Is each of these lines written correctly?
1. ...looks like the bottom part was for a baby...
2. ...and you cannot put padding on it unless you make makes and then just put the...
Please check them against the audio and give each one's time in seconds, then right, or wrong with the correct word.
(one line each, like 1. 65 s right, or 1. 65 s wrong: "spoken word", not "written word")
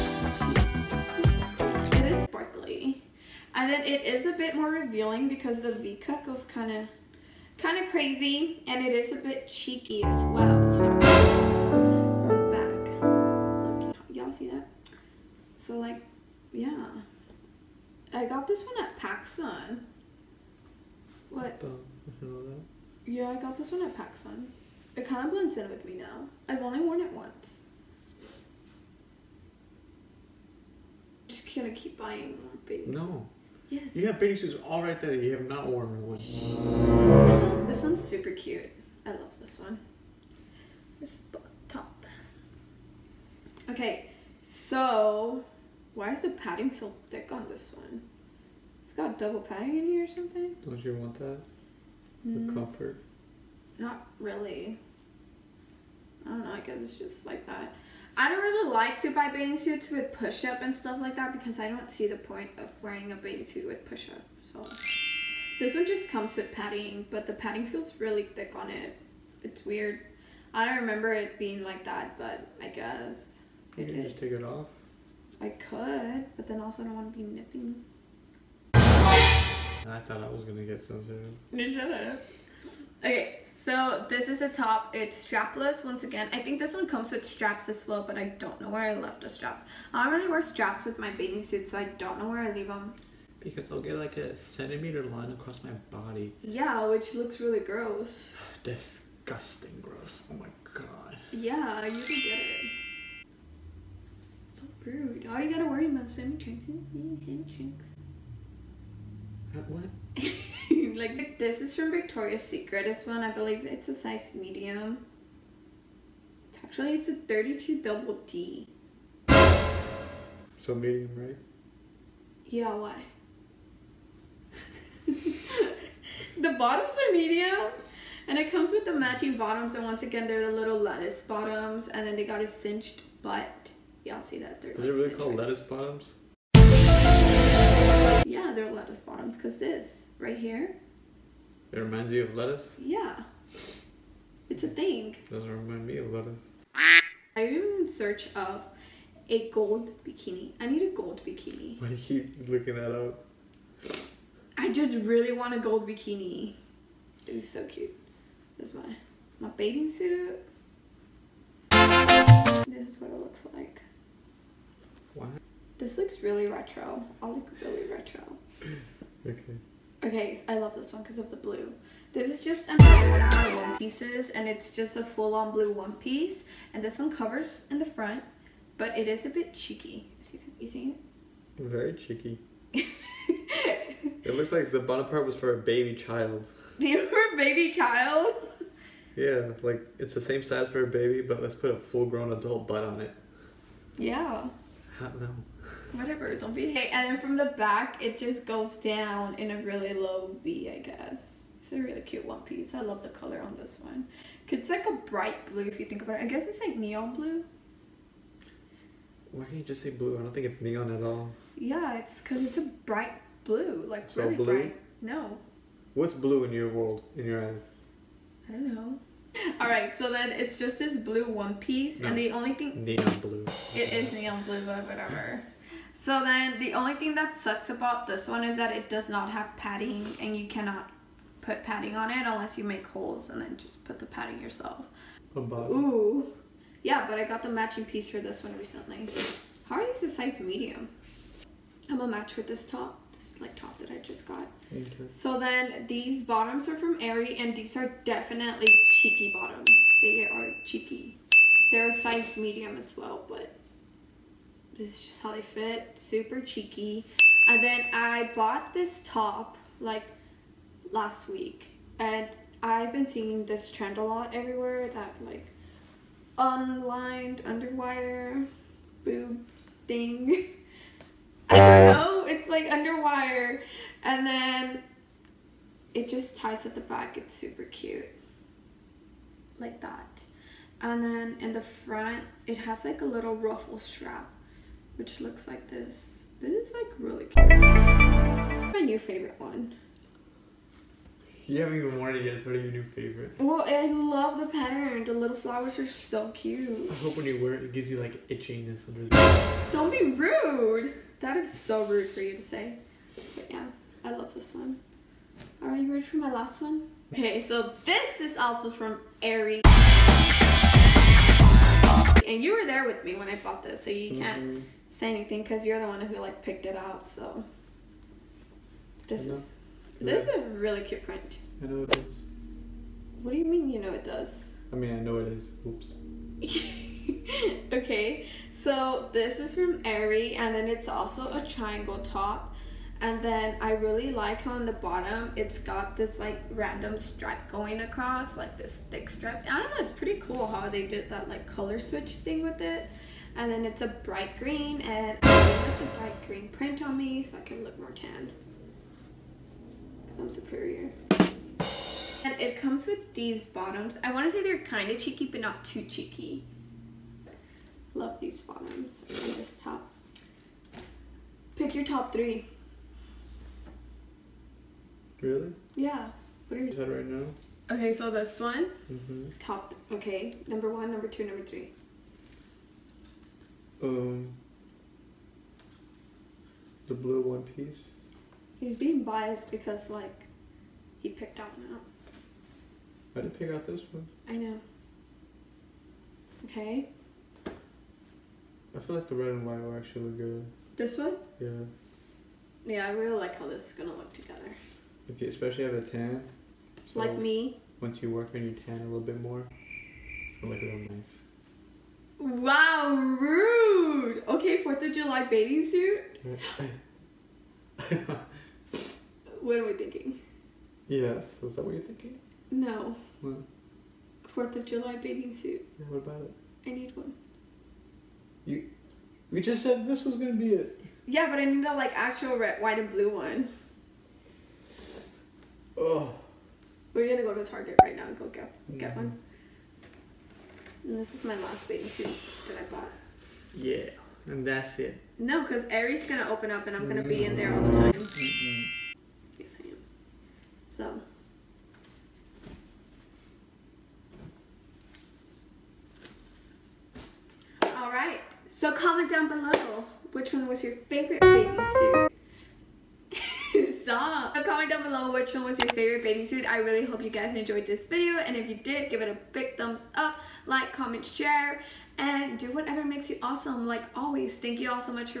1. 184 s right
2. 230 s wrong: "holes", not "makes".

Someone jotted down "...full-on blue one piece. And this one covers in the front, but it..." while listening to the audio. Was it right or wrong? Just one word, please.
right.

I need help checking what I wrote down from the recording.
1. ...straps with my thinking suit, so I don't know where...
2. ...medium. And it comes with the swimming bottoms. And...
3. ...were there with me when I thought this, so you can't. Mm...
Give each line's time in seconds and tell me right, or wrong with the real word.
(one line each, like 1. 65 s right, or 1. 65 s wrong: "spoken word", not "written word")
1. 90 s wrong: "bathing", not "thinking"
2. 127 s wrong: "matching", not "swimming"
3. 312 s wrong: "bought", not "thought".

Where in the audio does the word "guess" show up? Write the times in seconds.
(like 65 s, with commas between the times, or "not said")
56 s, 72 s, 200 s, 206 s.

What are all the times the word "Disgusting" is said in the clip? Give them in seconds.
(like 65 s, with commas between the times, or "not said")
98 s.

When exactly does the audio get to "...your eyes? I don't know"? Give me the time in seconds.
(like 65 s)
217 s.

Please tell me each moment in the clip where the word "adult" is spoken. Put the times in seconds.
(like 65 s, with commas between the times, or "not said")
192 s.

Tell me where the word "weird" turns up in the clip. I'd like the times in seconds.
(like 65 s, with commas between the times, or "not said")
69 s.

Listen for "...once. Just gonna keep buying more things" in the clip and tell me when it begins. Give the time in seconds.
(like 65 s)
27 s.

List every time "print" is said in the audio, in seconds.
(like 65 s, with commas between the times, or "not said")
321 s, 346 s.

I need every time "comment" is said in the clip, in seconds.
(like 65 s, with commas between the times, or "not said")
448 s, 454 s, 460 s.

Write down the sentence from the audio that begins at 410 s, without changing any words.
Yes, is that what you're thinking?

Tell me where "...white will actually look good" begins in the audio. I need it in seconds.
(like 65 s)
389 s.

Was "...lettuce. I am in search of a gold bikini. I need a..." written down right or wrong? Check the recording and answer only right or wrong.
right.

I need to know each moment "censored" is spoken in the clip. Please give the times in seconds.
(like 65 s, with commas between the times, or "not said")
80 s.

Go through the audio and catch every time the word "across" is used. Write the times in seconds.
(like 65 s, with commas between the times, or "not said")
95 s, 337 s.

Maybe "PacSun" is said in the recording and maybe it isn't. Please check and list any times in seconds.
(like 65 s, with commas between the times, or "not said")
18 s, 23 s.